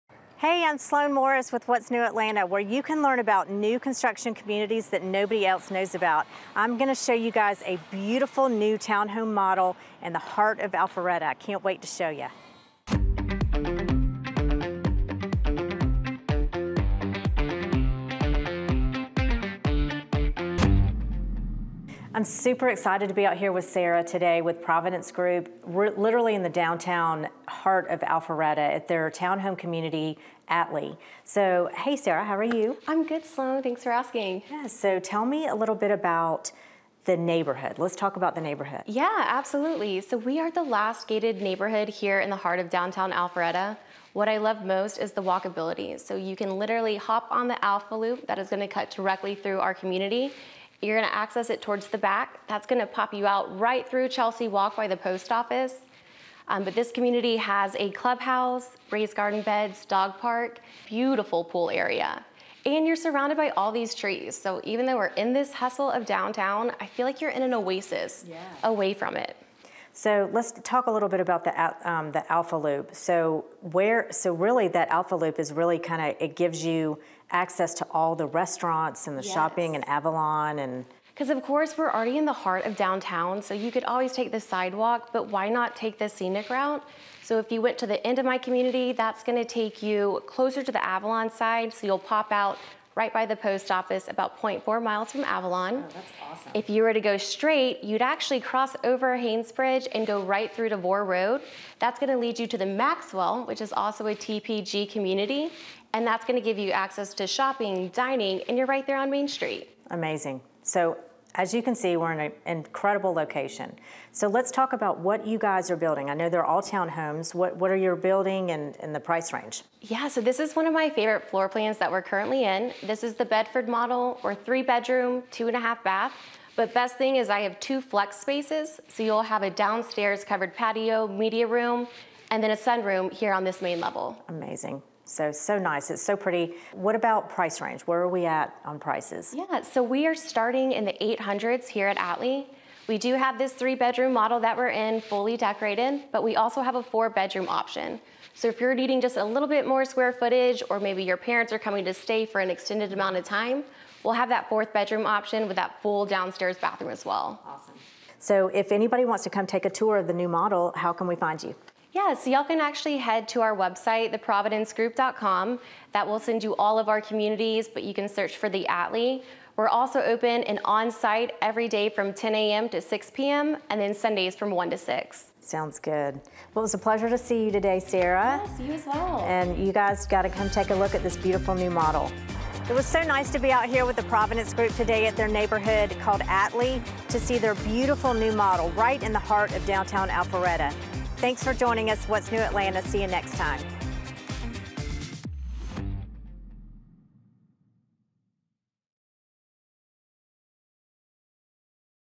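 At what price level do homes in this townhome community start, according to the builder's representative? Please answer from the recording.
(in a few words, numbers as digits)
800s.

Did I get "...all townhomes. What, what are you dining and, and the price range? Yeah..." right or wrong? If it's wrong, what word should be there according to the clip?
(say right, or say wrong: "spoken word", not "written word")
wrong: "building", not "dining".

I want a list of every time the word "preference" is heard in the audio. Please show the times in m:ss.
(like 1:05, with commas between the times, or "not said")
not said.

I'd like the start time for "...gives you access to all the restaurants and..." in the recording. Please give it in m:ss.
1:16.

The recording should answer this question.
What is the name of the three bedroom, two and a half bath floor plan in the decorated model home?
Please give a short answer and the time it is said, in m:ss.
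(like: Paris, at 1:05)
Bedford, at 2:03.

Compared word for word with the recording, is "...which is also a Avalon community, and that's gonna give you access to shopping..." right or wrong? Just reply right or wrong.
wrong.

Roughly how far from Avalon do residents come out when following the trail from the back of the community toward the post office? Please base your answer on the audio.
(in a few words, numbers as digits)
0.4 miles.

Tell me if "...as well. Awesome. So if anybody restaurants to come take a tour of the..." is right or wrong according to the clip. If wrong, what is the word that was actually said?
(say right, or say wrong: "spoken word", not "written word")
wrong: "wants", not "restaurants".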